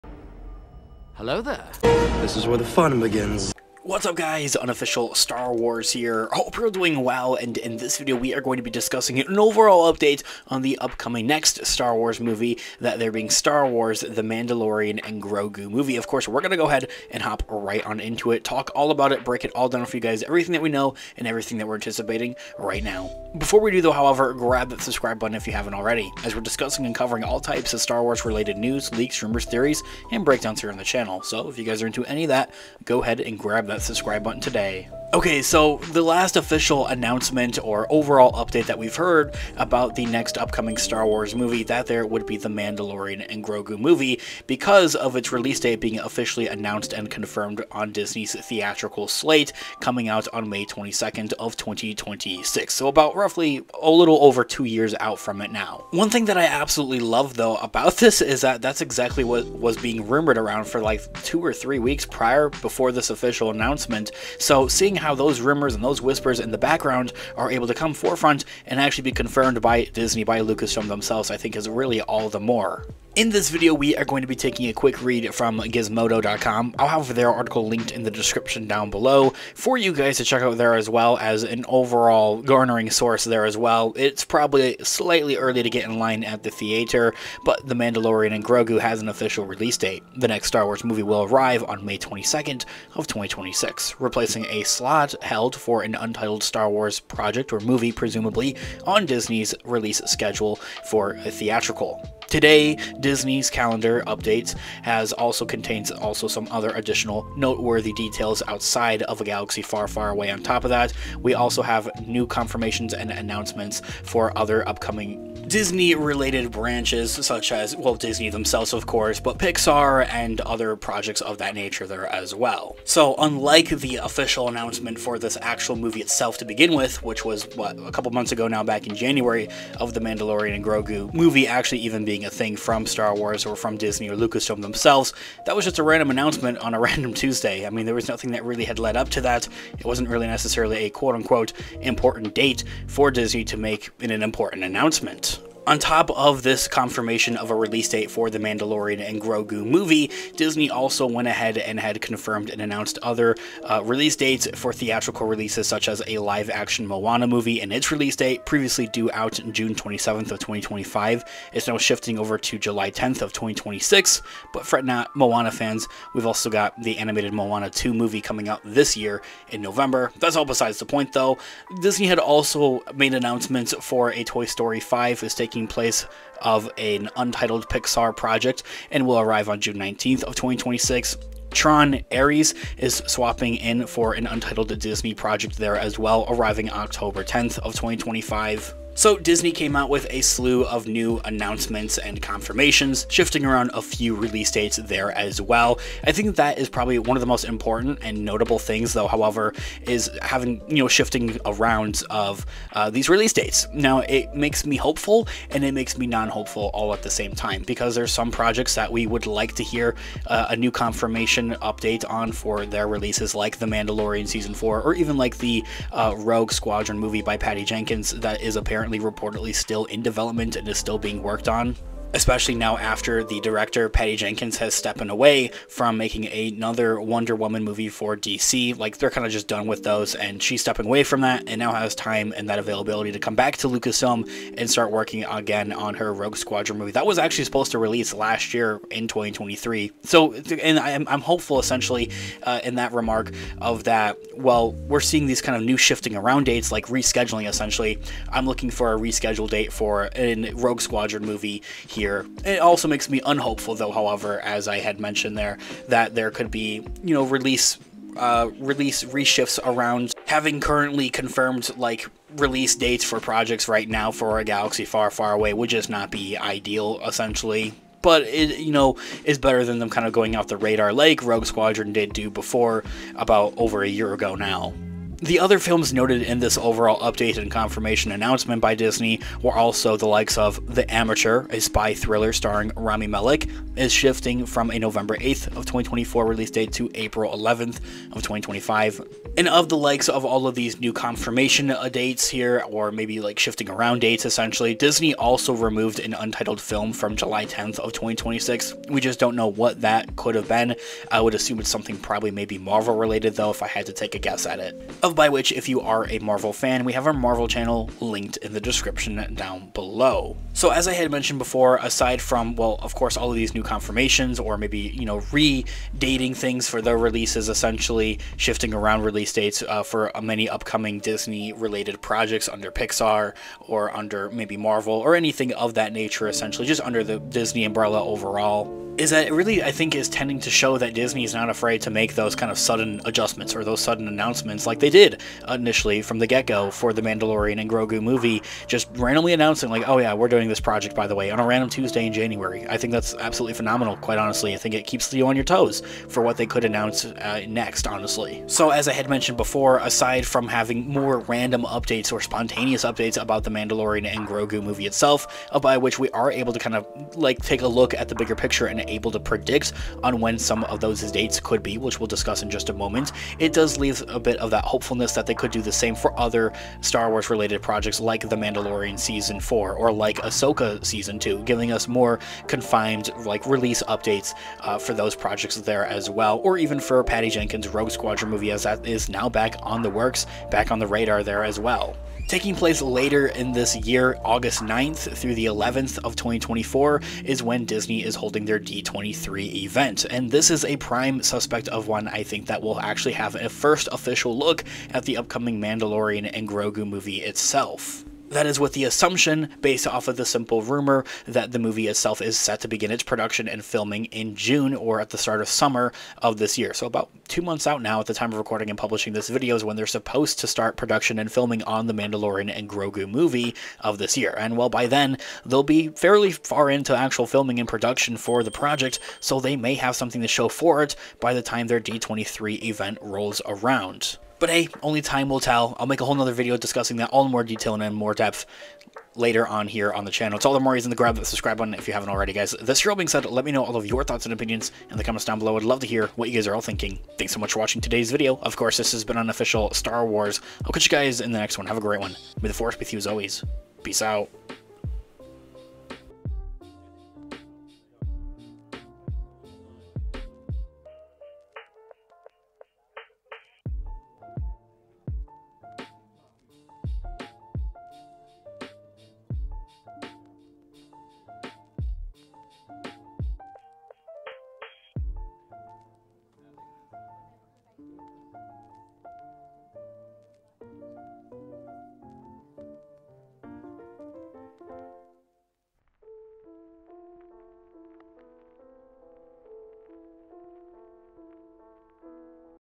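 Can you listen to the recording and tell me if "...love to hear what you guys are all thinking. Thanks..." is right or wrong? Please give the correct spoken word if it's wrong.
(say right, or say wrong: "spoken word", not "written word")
right.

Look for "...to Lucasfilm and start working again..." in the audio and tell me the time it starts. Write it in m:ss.
3:53.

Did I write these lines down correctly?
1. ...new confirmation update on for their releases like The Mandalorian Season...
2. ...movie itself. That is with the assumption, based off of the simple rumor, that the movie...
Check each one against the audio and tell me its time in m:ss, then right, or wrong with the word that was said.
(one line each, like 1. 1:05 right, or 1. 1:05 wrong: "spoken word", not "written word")
1. 3:30 right
2. 6:36 right.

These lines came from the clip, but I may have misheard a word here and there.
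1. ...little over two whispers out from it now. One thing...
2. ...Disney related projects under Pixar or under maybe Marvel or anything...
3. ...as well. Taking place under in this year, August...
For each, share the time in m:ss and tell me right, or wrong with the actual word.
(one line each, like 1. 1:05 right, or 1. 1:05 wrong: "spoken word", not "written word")
1. 0:53 wrong: "years", not "whispers"
2. 5:20 right
3. 6:21 wrong: "later", not "under".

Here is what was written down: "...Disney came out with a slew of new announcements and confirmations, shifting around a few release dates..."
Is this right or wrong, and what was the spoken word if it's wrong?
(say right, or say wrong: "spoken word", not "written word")
right.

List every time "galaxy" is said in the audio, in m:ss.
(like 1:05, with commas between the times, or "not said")
1:49, 4:24.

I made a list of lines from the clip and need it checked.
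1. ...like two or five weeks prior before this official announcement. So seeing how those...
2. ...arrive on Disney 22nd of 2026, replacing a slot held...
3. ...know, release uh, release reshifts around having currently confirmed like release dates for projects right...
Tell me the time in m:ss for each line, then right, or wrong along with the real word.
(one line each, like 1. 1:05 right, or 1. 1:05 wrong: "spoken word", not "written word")
1. 1:00 wrong: "three", not "five"
2. 1:31 wrong: "May", not "Disney"
3. 4:17 right.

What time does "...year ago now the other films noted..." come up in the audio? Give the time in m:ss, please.
4:33.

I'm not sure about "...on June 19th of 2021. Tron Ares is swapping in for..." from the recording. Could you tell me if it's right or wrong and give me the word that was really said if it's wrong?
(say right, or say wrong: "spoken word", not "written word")
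wrong: "2026", not "2021".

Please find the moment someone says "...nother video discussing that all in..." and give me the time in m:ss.
7:06.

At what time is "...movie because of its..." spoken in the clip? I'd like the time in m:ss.
0:43.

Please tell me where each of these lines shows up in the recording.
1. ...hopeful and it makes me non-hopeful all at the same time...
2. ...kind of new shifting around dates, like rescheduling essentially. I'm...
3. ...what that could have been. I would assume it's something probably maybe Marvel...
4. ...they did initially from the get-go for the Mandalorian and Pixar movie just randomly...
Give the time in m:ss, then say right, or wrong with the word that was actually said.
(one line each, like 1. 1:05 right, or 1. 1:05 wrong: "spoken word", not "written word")
1. 3:24 right
2. 4:05 right
3. 4:59 right
4. 5:34 wrong: "Grogu", not "Pixar".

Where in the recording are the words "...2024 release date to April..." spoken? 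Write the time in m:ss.
4:45.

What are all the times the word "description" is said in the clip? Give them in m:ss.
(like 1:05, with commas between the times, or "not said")
1:18, 5:08.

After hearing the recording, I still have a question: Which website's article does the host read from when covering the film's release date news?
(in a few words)
Gizmodo.com.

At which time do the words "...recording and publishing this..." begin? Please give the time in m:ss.
6:48.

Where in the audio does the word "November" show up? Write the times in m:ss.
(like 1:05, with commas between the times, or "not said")
2:49, 4:44.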